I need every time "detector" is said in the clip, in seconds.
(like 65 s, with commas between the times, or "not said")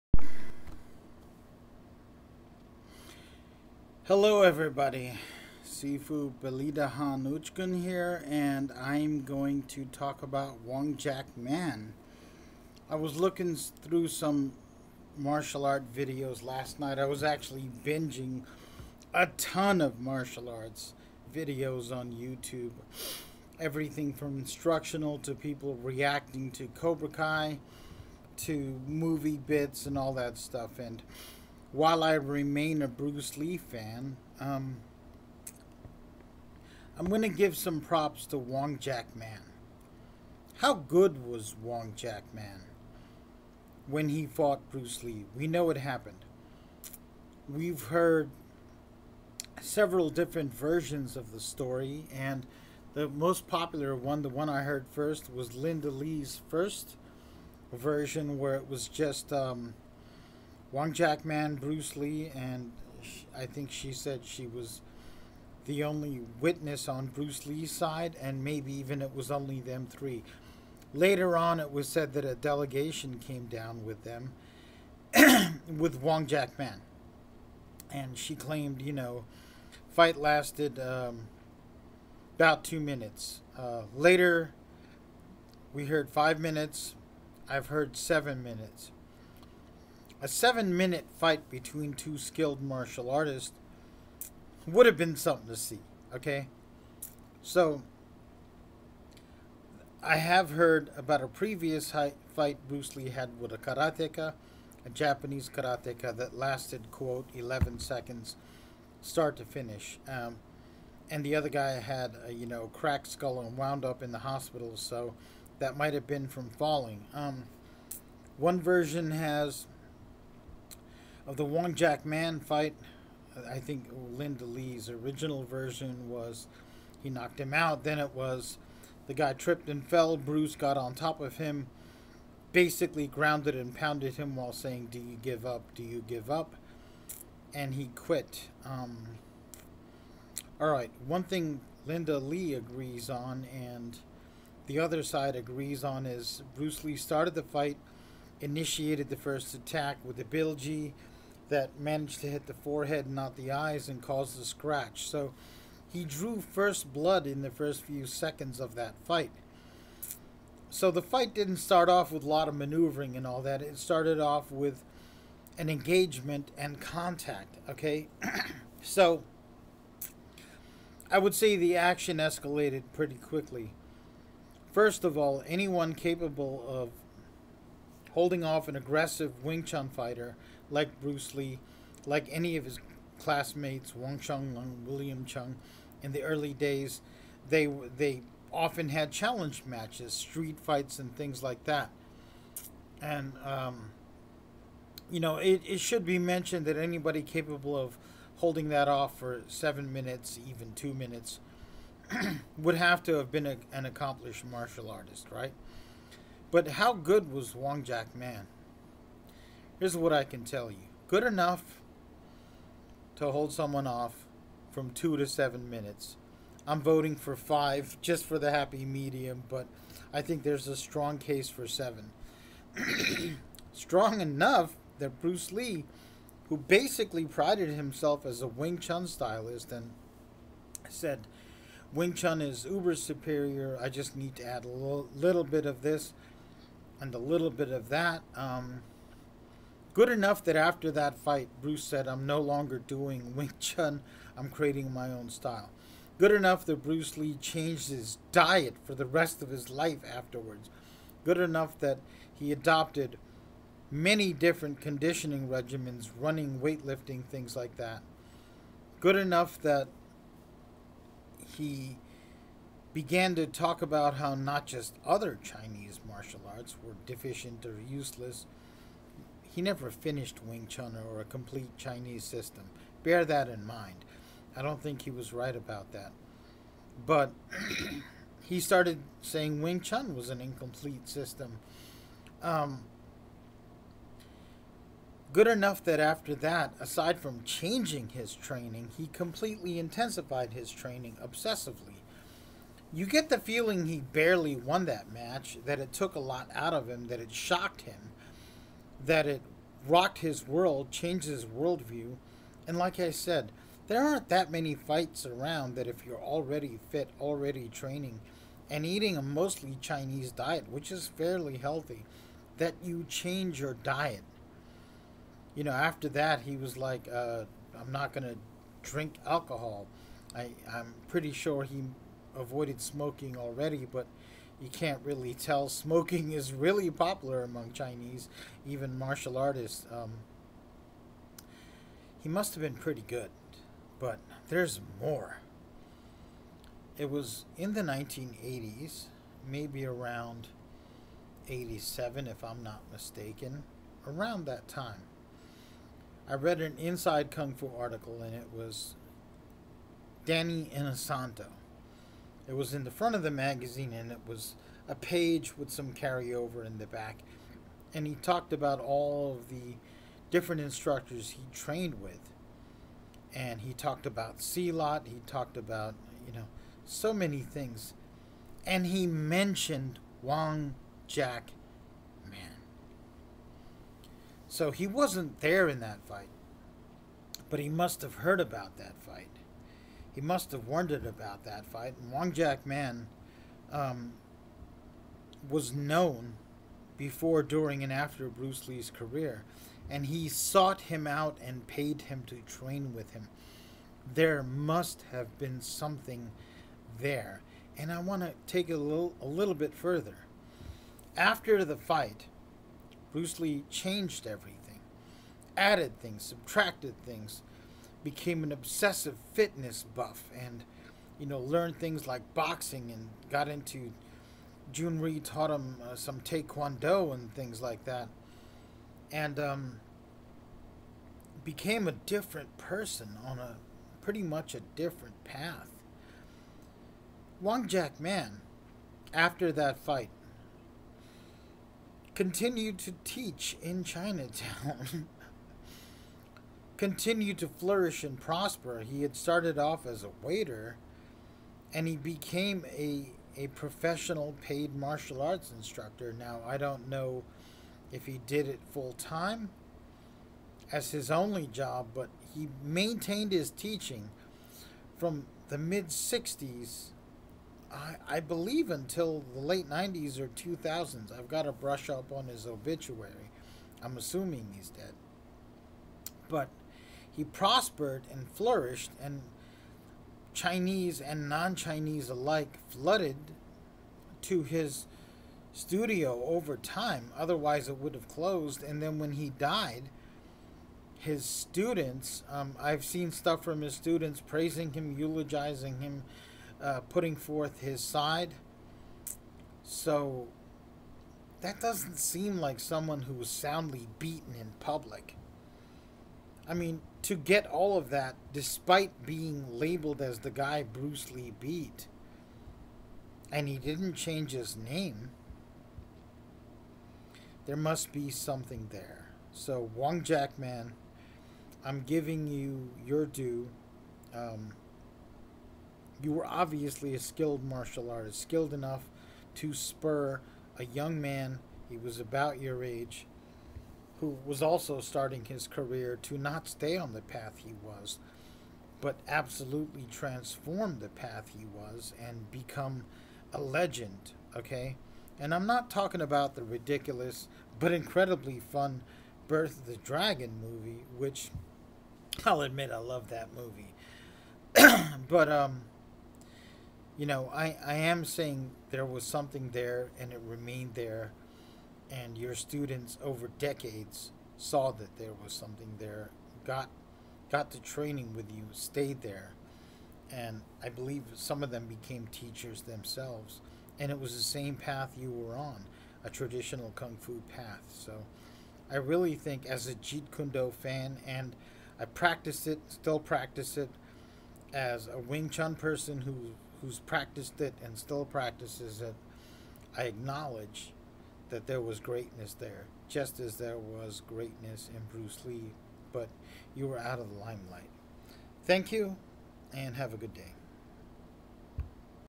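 not said.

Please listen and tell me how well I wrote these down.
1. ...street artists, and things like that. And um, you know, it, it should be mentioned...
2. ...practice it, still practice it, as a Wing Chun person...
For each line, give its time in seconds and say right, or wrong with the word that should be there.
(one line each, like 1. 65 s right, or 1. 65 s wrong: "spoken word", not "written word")
1. 190 s wrong: "fights", not "artists"
2. 571 s right.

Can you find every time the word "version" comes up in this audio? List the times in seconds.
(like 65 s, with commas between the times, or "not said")
50 s, 57 s, 118 s, 125 s.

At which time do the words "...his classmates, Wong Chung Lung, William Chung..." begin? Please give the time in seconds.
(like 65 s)
182 s.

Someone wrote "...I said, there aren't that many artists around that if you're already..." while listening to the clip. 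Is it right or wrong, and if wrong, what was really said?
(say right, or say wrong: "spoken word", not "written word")
wrong: "fights", not "artists".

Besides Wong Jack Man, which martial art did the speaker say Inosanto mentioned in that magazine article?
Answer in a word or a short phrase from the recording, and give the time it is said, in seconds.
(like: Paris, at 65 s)
Silat, at 364 s.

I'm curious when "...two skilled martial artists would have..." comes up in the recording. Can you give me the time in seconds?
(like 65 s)
91 s.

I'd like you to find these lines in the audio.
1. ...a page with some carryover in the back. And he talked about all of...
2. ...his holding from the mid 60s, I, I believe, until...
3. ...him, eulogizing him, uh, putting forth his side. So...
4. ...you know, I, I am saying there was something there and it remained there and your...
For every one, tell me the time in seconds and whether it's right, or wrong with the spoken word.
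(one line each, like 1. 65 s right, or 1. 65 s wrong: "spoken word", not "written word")
1. 354 s right
2. 453 s wrong: "teaching", not "holding"
3. 484 s right
4. 546 s right.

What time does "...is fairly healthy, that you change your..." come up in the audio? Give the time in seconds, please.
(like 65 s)
310 s.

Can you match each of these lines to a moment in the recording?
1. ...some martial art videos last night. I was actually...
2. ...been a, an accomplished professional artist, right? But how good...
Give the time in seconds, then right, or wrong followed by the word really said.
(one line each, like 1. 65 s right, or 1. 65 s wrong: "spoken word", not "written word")
1. 14 s right
2. 203 s wrong: "martial", not "professional".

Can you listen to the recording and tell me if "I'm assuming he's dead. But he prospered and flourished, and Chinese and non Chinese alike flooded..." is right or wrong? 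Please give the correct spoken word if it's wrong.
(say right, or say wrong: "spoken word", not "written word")
right.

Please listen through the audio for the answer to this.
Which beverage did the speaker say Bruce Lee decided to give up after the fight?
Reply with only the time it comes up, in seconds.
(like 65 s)
319 s.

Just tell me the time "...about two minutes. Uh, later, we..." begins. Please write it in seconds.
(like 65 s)
82 s.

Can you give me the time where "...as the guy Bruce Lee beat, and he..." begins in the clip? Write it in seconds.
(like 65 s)
500 s.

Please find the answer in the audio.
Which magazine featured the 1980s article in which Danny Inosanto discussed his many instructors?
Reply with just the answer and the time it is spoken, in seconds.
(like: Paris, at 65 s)
Inside Kung Fu, at 346 s.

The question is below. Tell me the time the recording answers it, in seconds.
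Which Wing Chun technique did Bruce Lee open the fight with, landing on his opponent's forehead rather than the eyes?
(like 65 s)
150 s.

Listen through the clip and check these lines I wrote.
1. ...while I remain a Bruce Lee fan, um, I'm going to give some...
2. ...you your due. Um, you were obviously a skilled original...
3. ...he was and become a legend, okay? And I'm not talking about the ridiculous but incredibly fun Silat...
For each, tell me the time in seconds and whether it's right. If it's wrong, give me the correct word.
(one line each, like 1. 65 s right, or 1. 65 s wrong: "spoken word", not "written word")
1. 31 s right
2. 512 s wrong: "martial", not "original"
3. 531 s wrong: "Birth", not "Silat".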